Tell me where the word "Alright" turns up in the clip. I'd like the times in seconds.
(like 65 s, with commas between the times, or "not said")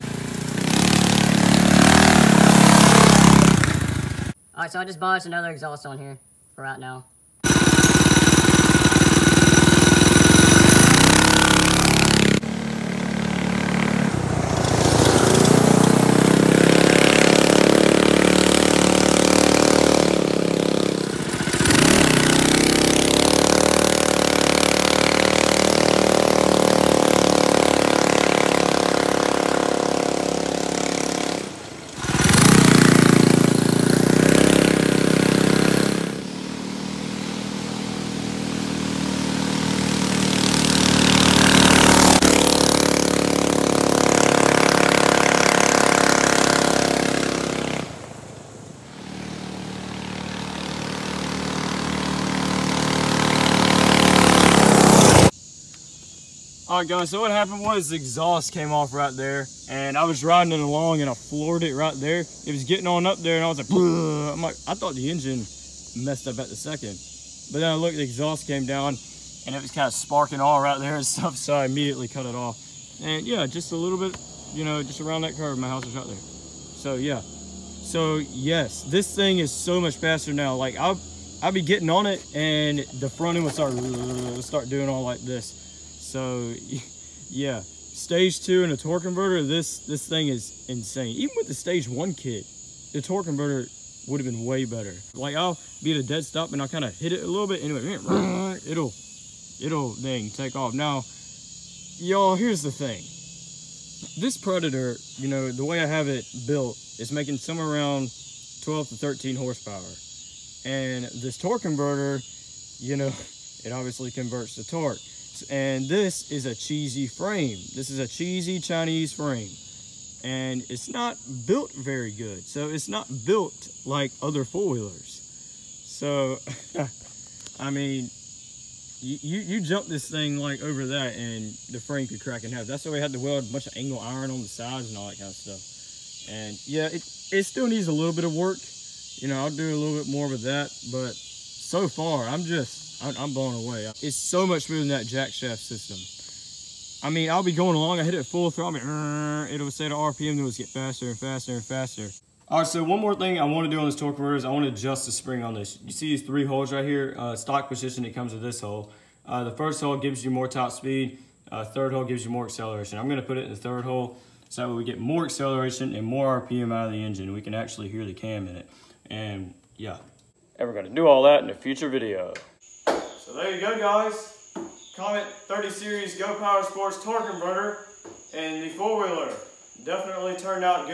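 4 s, 56 s.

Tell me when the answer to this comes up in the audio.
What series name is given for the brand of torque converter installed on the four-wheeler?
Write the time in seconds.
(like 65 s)
175 s.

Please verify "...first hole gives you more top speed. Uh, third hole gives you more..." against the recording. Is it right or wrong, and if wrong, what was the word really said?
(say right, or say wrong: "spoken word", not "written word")
right.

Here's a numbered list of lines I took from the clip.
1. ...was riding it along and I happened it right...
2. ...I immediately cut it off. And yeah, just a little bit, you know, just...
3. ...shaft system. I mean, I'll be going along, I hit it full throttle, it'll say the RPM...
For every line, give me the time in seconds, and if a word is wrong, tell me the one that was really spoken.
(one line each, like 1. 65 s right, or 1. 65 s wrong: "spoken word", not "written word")
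1. 60 s wrong: "floored", not "happened"
2. 71 s right
3. 145 s right.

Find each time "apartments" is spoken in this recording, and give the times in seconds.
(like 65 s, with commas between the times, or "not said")
not said.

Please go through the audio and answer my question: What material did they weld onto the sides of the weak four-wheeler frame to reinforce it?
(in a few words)
angle iron.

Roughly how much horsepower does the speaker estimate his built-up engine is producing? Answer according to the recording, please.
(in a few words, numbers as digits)
12 to 13 horsepower.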